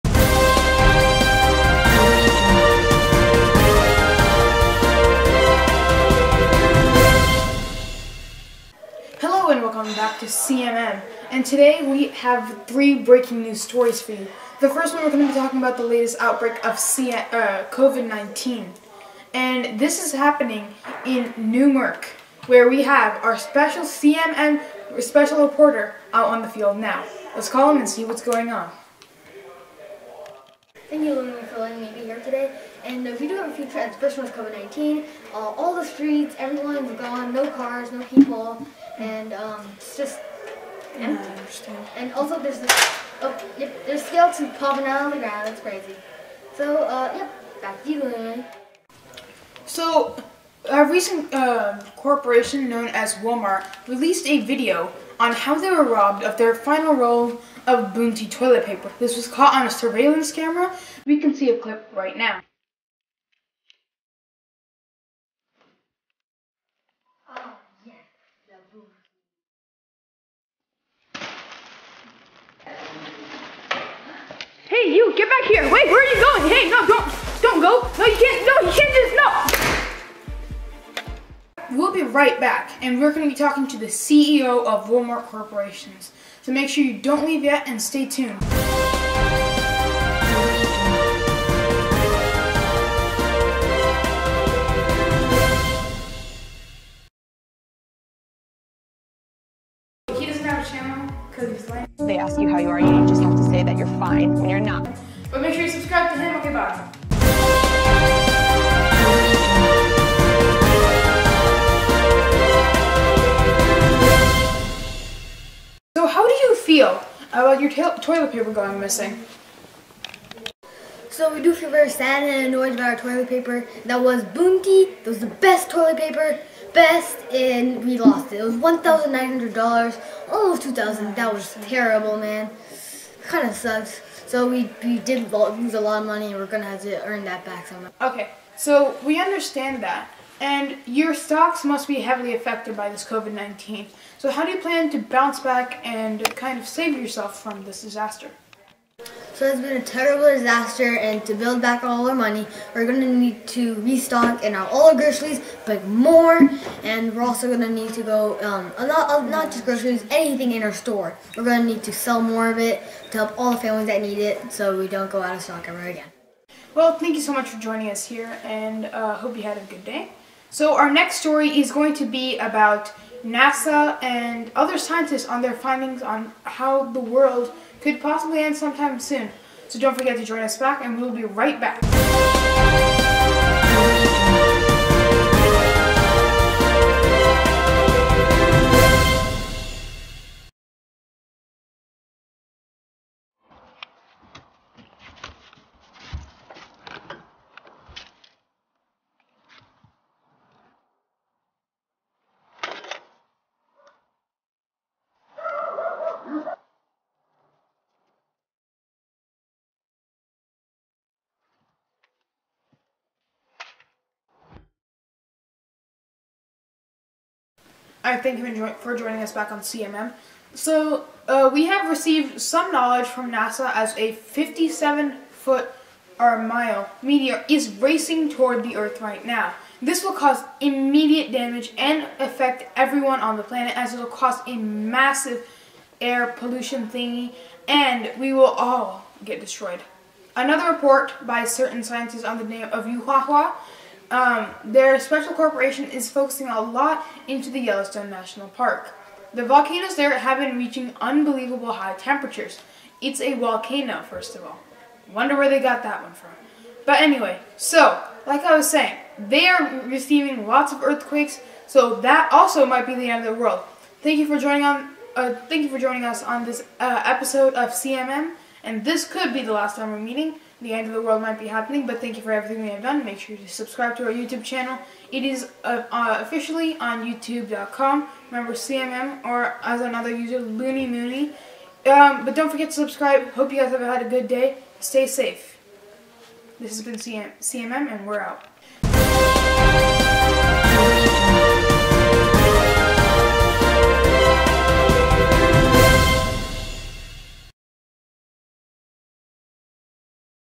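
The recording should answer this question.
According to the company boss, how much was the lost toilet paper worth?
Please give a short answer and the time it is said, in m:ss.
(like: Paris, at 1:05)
$1,900, at 2:08.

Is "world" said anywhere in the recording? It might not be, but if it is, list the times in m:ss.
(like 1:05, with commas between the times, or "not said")
2:56, 4:23, 4:31.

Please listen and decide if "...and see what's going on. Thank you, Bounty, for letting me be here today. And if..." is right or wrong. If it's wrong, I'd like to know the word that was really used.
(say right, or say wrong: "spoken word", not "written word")
wrong: "Lumi", not "Bounty".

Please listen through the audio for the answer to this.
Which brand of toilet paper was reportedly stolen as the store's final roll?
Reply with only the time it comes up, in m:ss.
0:57.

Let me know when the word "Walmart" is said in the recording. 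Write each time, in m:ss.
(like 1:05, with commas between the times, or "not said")
0:53, 1:24.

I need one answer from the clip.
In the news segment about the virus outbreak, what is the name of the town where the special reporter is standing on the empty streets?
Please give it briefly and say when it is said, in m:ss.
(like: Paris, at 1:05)
Newmark, at 0:21.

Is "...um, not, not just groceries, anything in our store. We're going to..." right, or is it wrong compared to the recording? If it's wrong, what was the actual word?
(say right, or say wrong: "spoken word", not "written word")
right.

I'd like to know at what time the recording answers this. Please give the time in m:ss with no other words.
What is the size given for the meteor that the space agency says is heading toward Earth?
3:44.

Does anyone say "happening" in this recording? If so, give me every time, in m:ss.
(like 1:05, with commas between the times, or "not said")
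0:20, 4:31.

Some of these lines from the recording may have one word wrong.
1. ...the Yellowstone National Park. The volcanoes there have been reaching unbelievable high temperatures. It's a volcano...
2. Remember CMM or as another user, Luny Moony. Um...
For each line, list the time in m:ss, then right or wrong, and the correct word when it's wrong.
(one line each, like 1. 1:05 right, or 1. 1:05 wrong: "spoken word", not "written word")
1. 4:07 right
2. 4:38 right.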